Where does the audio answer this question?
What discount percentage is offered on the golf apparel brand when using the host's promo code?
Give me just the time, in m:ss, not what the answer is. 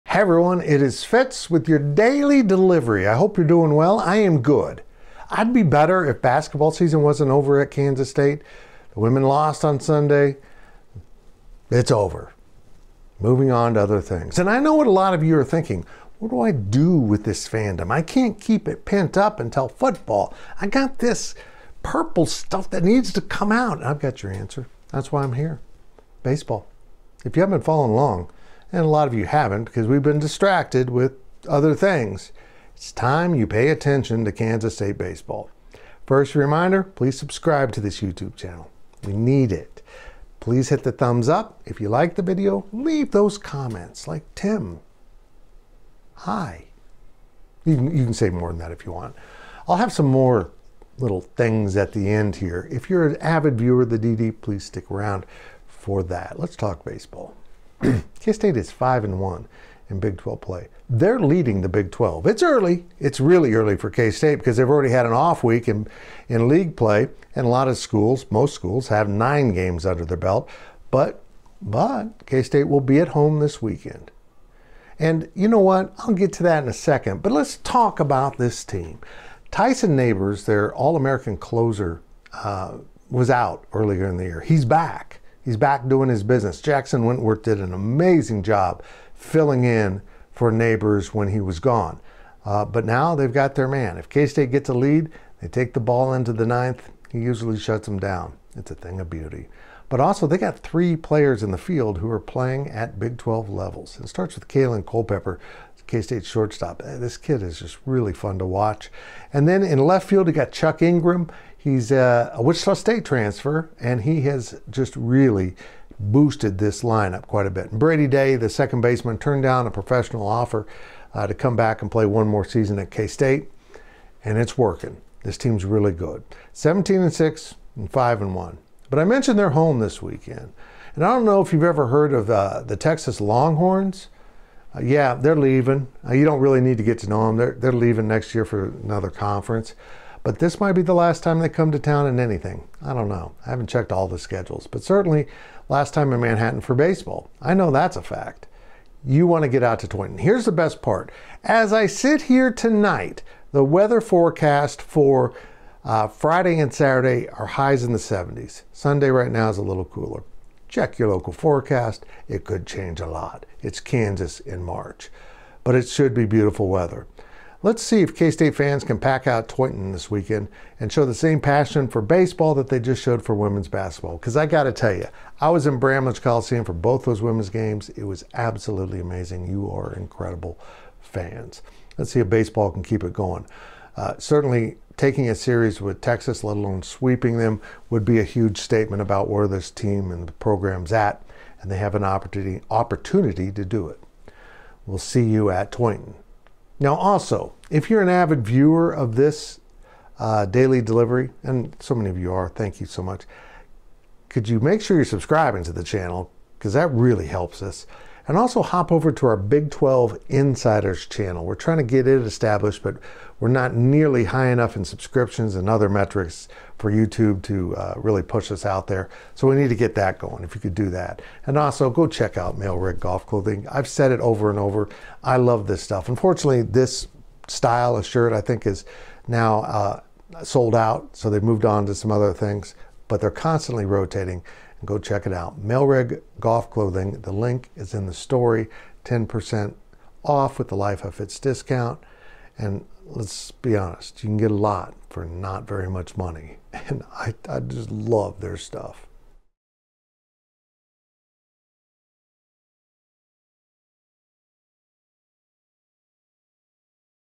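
3:59.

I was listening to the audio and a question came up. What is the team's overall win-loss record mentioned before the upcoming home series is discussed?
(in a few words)
17-6.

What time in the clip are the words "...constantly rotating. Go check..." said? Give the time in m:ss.
3:53.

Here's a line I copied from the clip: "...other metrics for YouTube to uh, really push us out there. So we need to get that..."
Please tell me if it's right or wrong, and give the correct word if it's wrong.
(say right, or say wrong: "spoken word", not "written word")
right.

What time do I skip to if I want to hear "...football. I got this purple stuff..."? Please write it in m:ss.
0:19.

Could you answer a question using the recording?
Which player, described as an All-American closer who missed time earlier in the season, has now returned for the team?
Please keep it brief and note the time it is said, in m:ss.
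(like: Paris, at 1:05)
Tyson Neighbors, at 1:19.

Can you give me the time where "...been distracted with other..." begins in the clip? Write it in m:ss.
0:30.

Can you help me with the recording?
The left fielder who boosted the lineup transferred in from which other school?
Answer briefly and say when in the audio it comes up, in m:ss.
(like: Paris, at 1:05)
Wichita State, at 1:52.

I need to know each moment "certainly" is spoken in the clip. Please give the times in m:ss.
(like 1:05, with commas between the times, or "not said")
2:24, 3:04.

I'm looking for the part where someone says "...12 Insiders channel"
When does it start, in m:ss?
3:29.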